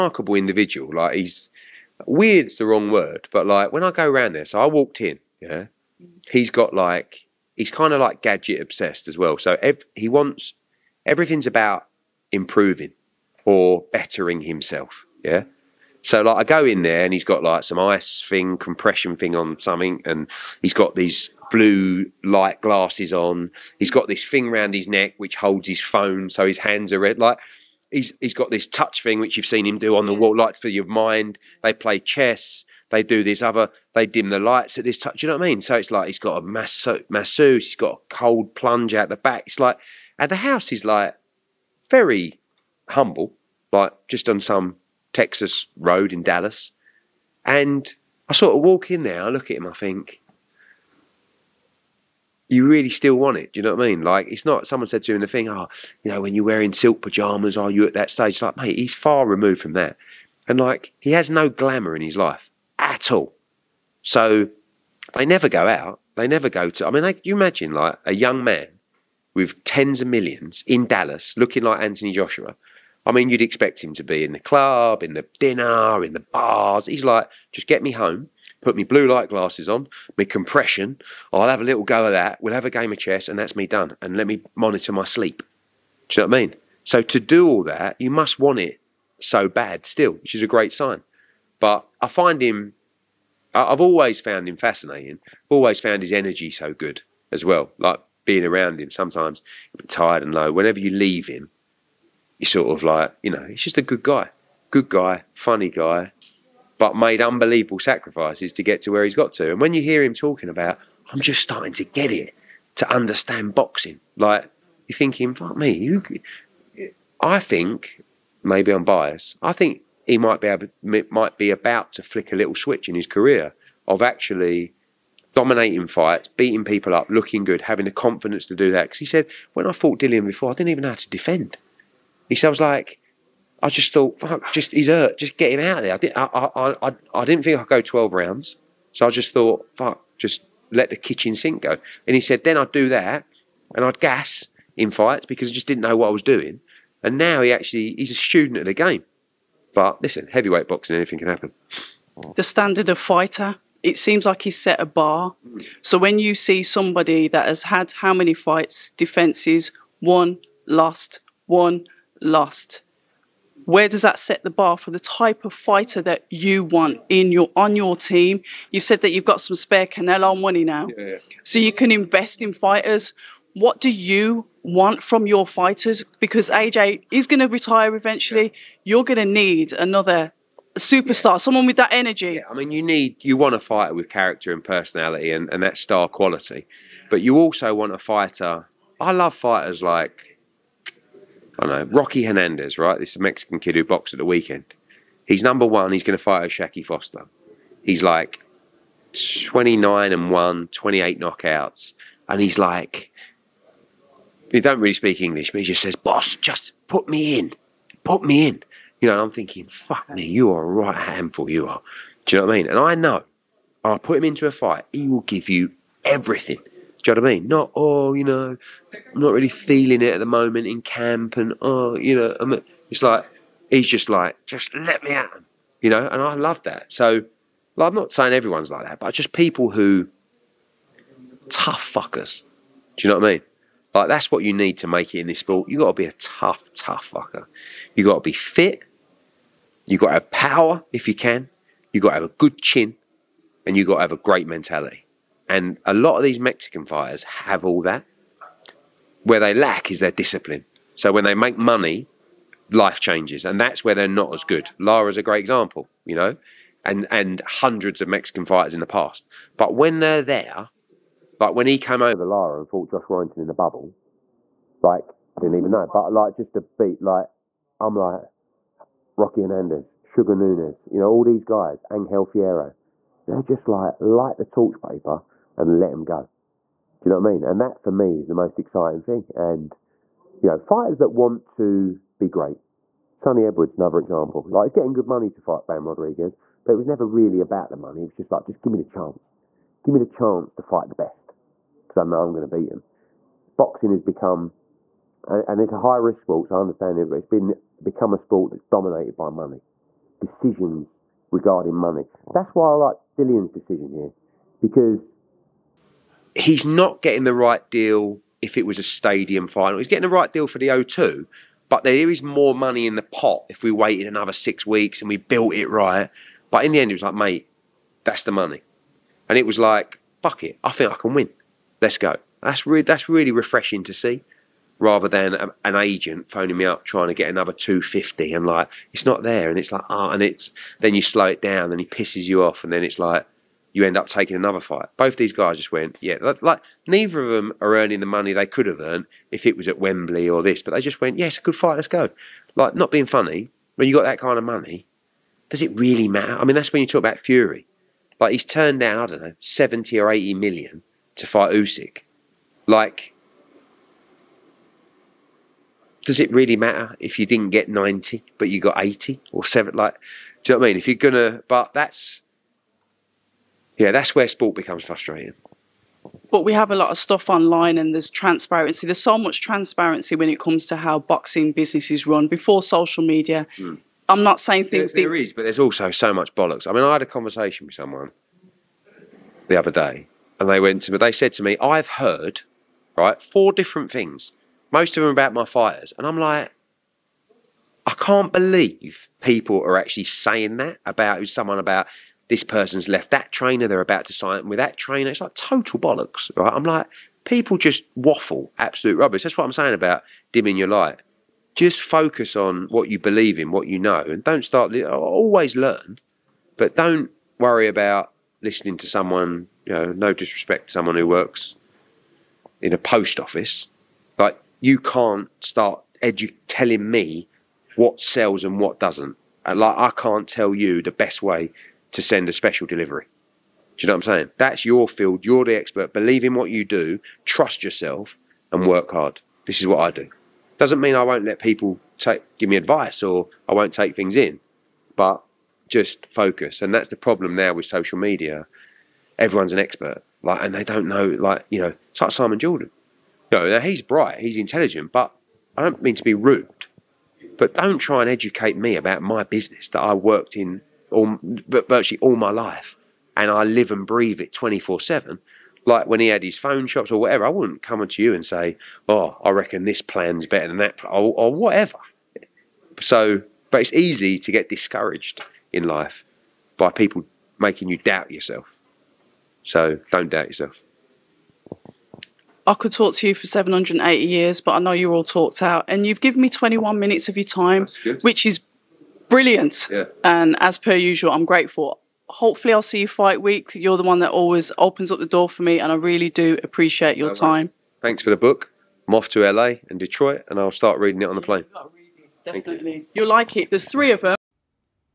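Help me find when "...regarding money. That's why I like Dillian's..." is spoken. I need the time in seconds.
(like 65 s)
301 s.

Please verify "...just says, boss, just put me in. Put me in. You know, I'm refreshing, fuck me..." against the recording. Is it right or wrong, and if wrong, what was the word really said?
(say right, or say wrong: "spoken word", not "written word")
wrong: "thinking", not "refreshing".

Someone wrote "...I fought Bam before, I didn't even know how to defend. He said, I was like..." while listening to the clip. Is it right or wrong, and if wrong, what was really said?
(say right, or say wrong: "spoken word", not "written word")
wrong: "Dillian", not "Bam".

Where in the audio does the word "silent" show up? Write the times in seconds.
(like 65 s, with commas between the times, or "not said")
not said.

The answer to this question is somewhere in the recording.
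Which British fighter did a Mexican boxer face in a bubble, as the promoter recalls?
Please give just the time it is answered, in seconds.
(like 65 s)
262 s.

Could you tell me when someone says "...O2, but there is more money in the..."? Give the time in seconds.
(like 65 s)
310 s.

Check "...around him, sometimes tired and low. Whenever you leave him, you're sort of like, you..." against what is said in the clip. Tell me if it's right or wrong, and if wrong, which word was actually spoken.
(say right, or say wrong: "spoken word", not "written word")
right.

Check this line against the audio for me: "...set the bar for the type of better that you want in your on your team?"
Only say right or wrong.
wrong.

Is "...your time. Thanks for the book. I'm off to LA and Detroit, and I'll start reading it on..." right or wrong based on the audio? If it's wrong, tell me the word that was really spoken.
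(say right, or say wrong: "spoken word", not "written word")
right.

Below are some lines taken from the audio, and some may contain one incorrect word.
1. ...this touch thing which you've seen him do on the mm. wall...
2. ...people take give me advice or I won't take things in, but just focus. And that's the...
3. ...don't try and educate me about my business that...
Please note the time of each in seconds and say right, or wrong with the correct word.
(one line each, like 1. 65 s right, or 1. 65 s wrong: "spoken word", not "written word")
1. 28 s right
2. 431 s right
3. 447 s right.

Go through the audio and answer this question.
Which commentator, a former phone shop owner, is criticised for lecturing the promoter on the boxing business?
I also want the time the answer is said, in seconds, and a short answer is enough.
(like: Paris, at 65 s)
Simon Jordan, at 442 s.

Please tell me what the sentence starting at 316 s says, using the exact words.
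But in the end, it was like, mate, that's the money.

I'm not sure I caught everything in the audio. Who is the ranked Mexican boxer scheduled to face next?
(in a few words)
Shaki Foster.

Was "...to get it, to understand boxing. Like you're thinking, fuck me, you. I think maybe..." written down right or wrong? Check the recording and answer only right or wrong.
right.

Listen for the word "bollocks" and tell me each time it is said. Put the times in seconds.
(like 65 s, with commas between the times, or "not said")
376 s, 395 s.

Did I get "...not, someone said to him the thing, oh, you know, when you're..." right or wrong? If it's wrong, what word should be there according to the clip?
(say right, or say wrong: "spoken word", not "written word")
right.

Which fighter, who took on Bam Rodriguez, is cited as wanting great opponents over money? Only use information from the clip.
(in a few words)
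Sunny Edwards.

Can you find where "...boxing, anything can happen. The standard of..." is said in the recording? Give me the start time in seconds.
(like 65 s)
150 s.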